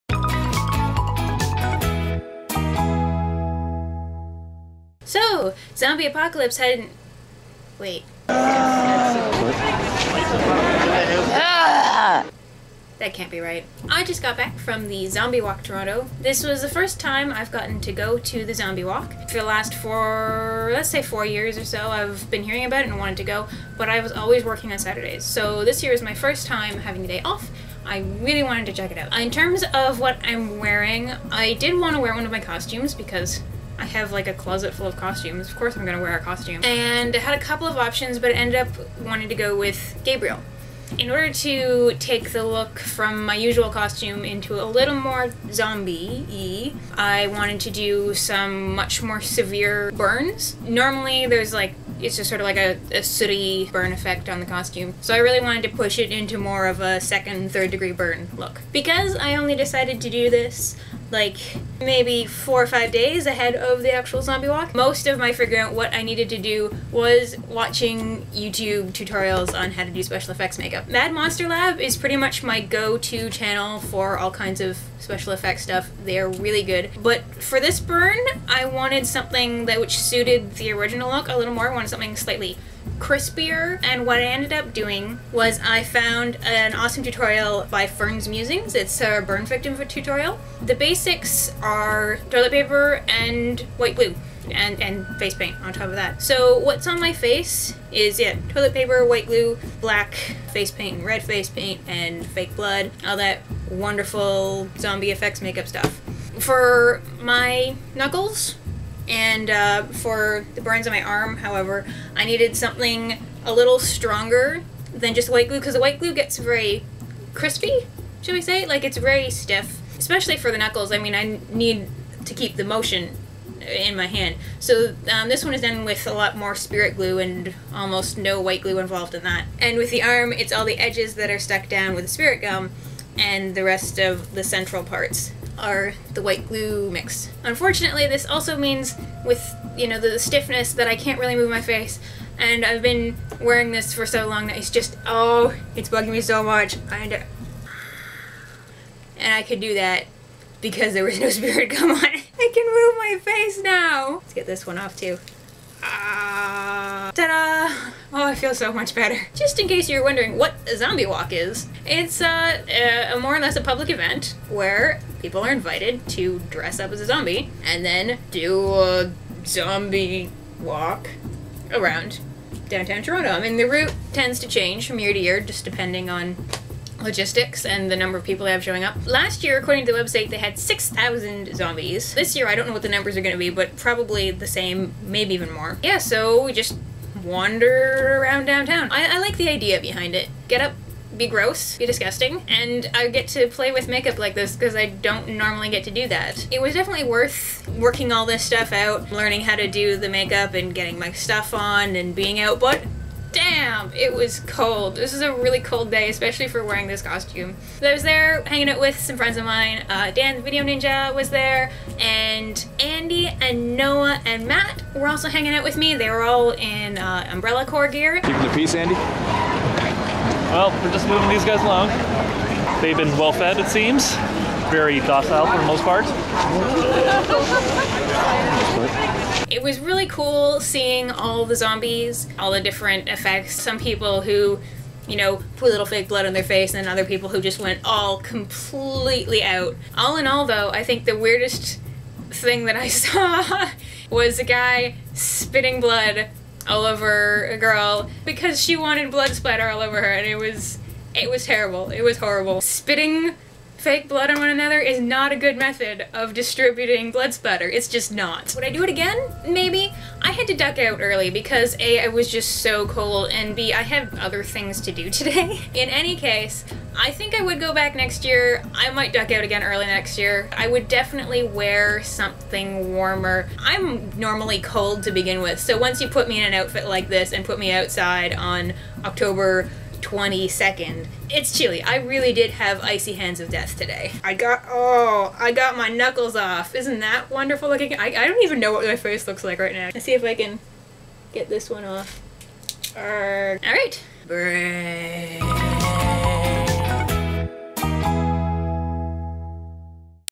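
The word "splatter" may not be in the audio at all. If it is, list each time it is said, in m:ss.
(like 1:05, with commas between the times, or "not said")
4:09, 4:17.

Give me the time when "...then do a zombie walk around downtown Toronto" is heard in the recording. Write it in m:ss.
2:47.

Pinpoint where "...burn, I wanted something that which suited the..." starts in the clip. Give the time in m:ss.
1:17.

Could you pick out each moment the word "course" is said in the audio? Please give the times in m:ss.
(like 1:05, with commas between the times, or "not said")
0:35.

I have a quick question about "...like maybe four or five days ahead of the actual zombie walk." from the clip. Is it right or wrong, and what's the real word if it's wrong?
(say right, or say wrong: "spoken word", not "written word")
right.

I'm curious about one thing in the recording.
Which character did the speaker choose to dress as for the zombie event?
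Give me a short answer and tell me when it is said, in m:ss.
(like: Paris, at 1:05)
Gabriel, at 0:40.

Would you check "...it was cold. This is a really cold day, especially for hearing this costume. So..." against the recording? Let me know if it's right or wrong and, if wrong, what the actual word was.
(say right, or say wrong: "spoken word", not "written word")
wrong: "wearing", not "hearing".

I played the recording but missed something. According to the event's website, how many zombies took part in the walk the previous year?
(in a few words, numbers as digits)
6,000.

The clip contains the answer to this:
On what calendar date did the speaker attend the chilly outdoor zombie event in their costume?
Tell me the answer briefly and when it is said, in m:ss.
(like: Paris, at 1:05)
October 22nd, at 4:39.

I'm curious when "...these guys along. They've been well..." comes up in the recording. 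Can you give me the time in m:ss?
3:41.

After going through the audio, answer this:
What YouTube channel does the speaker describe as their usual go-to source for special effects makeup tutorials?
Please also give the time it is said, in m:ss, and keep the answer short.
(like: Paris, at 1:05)
Mad Monster Lab, at 1:10.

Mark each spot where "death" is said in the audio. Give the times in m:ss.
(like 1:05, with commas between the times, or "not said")
4:43.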